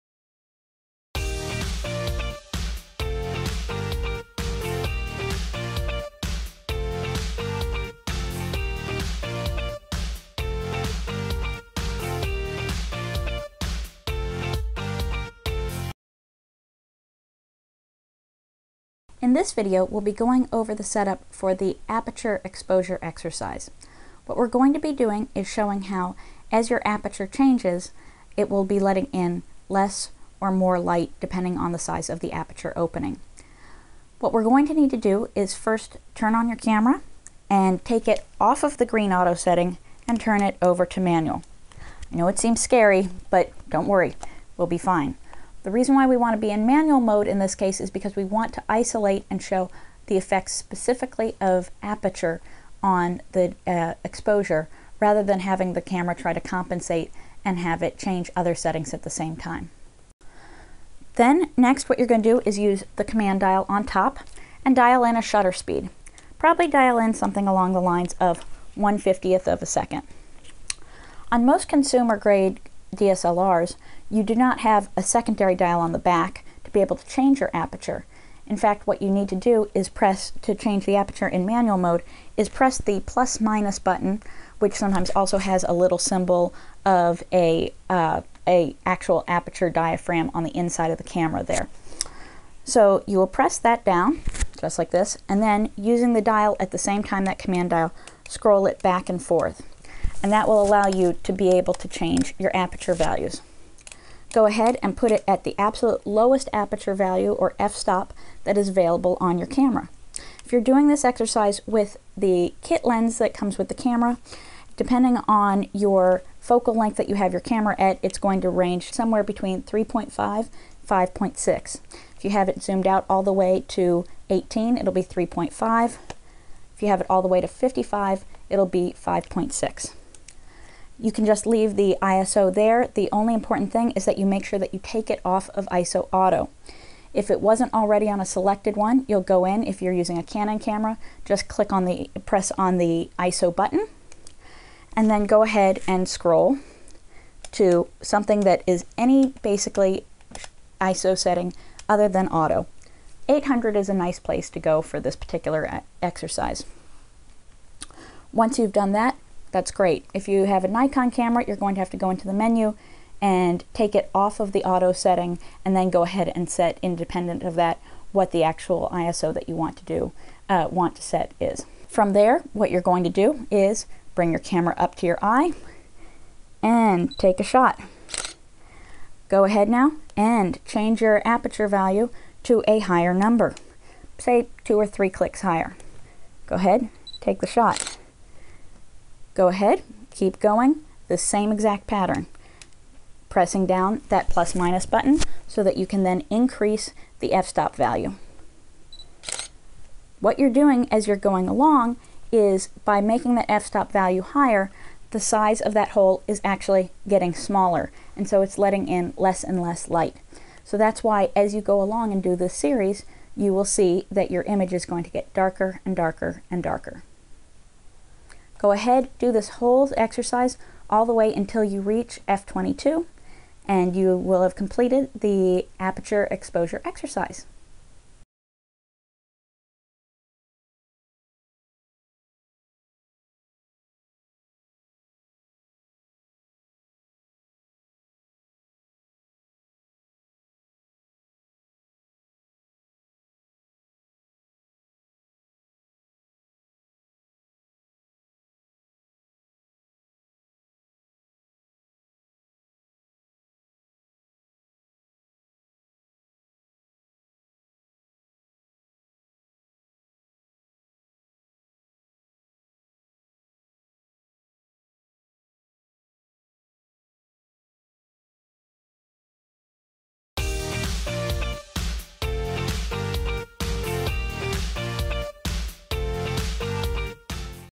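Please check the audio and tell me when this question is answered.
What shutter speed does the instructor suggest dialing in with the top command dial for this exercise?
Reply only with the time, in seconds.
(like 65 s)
68 s.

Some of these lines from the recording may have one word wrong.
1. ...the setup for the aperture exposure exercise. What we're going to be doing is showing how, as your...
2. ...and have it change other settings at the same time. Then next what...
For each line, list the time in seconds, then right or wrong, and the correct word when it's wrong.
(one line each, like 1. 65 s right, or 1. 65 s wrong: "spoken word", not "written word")
1. 20 s right
2. 57 s right.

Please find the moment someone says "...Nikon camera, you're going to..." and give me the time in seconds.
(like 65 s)
160 s.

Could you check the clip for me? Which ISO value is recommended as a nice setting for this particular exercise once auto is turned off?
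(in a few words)
800.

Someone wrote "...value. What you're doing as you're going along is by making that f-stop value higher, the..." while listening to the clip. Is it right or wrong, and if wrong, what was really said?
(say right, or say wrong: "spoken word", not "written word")
right.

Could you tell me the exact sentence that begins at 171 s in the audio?
From there, what you're going to do is bring your camera up to your eye and take a shot.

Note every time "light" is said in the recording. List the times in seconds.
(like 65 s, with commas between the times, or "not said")
30 s, 209 s.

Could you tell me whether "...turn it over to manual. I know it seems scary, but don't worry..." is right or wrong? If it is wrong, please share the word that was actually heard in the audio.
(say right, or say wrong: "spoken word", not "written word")
right.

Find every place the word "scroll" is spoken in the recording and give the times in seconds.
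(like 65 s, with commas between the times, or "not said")
98 s, 146 s.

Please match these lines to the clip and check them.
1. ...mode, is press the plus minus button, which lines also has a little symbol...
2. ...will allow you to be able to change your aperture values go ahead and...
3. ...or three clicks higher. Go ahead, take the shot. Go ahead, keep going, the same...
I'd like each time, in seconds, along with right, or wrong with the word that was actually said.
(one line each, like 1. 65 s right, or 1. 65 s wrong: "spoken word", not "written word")
1. 81 s wrong: "sometimes", not "lines"
2. 100 s right
3. 184 s right.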